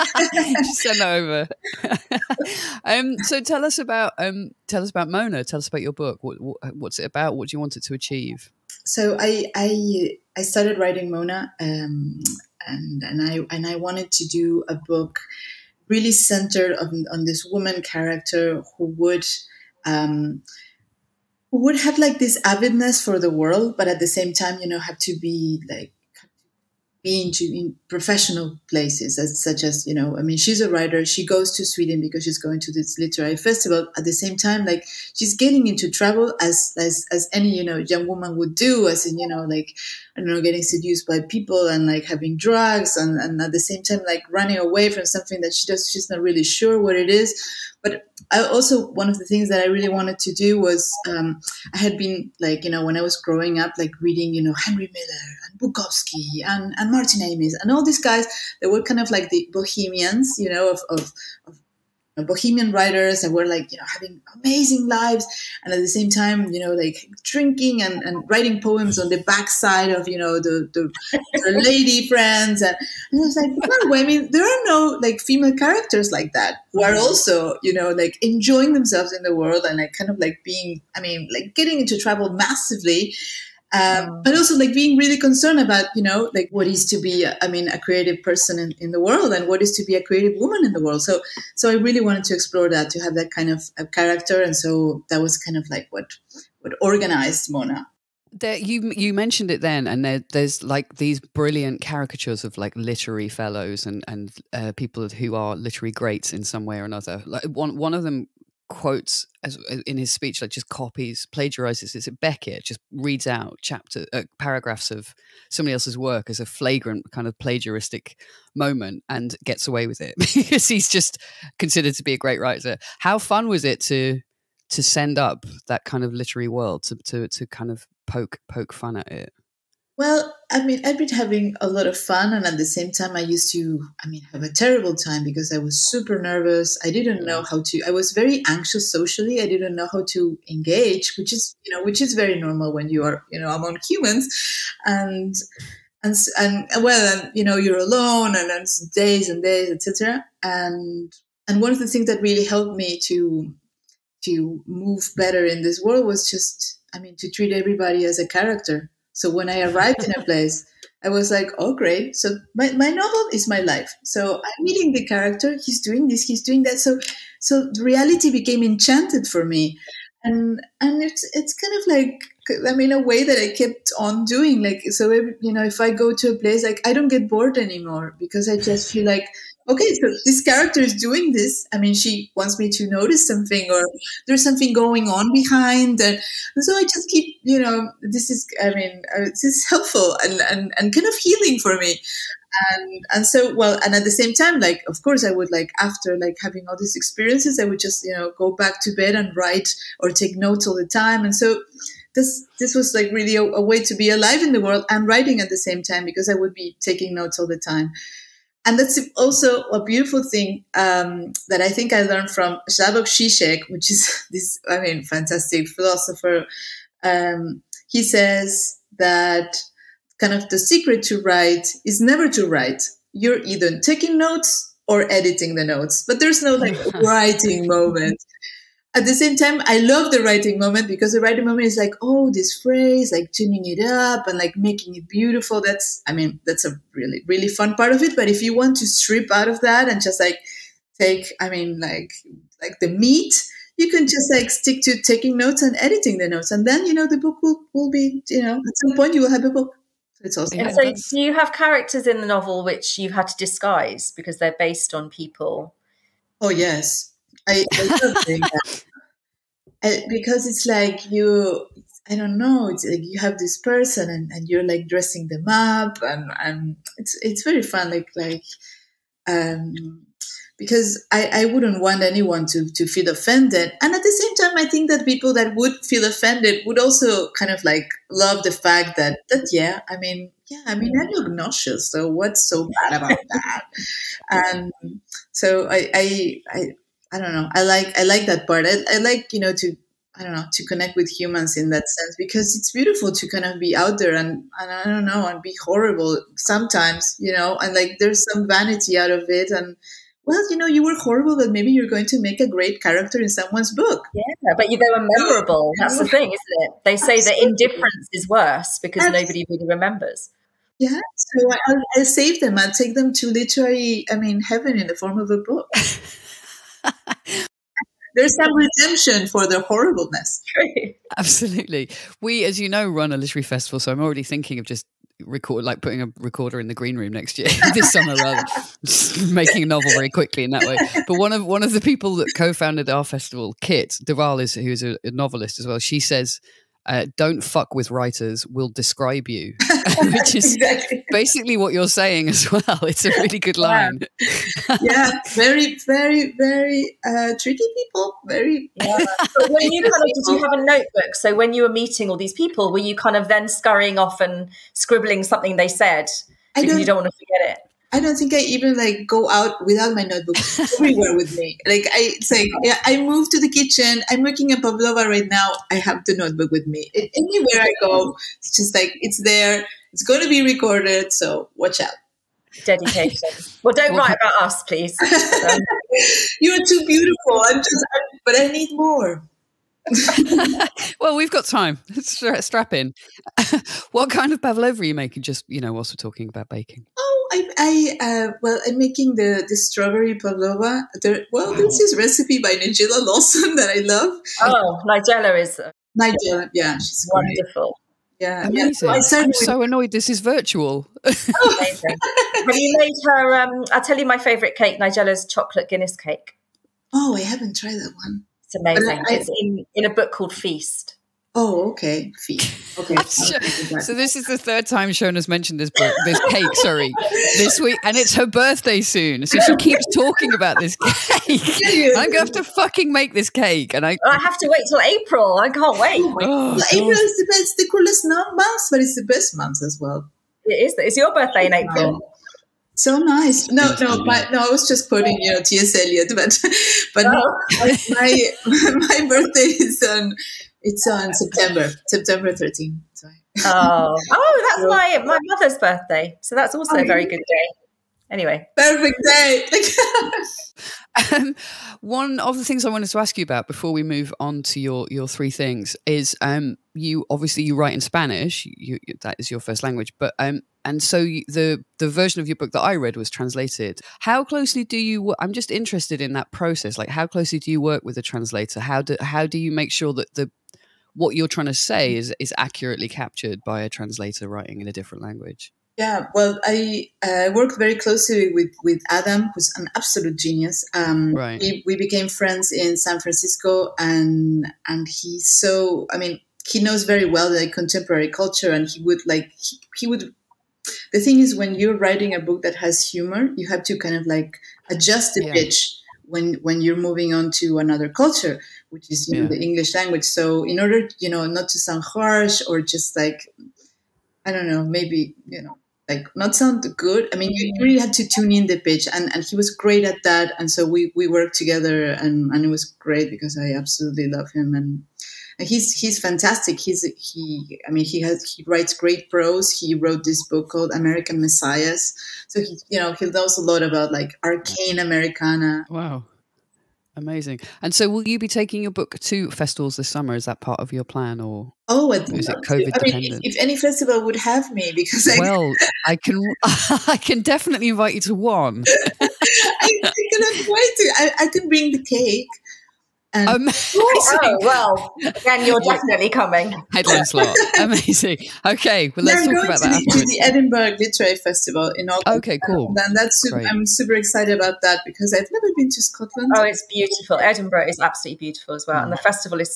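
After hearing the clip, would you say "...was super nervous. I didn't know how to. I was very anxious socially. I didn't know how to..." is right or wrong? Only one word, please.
right.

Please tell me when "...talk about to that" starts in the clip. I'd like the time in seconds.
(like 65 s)
549 s.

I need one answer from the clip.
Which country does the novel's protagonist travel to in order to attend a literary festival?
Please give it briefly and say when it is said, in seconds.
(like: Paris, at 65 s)
Sweden, at 31 s.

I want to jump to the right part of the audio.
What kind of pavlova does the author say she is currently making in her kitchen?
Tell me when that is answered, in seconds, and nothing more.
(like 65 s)
389 s.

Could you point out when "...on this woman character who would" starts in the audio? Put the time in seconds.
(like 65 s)
17 s.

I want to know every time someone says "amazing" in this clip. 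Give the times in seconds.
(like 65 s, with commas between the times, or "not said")
64 s, 398 s, 408 s, 526 s, 547 s.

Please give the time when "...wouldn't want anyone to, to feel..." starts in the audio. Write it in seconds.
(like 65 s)
271 s.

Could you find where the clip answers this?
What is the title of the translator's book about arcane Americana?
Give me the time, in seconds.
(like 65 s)
520 s.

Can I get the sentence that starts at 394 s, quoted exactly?
Oh, Nigella is uh, Nigella, yeah, she's wonderful.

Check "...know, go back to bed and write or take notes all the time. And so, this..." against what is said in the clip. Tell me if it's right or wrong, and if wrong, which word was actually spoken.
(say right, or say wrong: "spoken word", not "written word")
right.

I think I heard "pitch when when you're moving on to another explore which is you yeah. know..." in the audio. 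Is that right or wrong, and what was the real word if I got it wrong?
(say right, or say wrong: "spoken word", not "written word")
wrong: "culture", not "explore".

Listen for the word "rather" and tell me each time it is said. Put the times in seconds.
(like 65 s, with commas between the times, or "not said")
328 s.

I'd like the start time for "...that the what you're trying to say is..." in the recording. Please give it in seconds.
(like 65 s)
469 s.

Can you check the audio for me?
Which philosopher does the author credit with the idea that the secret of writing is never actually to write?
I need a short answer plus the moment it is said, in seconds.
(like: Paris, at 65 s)
Slavoj Žižek, at 212 s.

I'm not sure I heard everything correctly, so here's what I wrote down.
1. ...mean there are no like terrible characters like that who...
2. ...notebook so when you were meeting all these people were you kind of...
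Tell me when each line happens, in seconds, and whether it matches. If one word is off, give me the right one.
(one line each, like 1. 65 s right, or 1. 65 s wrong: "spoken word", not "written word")
1. 74 s wrong: "female", not "terrible"
2. 350 s right.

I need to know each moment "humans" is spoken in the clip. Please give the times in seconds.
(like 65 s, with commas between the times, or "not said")
143 s, 291 s.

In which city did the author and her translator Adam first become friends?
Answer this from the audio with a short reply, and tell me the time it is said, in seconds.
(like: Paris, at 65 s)
San Francisco, at 482 s.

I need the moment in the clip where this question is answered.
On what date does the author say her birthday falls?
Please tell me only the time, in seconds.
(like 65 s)
441 s.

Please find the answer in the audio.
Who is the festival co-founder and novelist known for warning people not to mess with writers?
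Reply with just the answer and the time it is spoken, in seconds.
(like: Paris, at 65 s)
Kit Deval, at 333 s.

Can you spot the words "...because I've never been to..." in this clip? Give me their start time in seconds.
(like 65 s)
554 s.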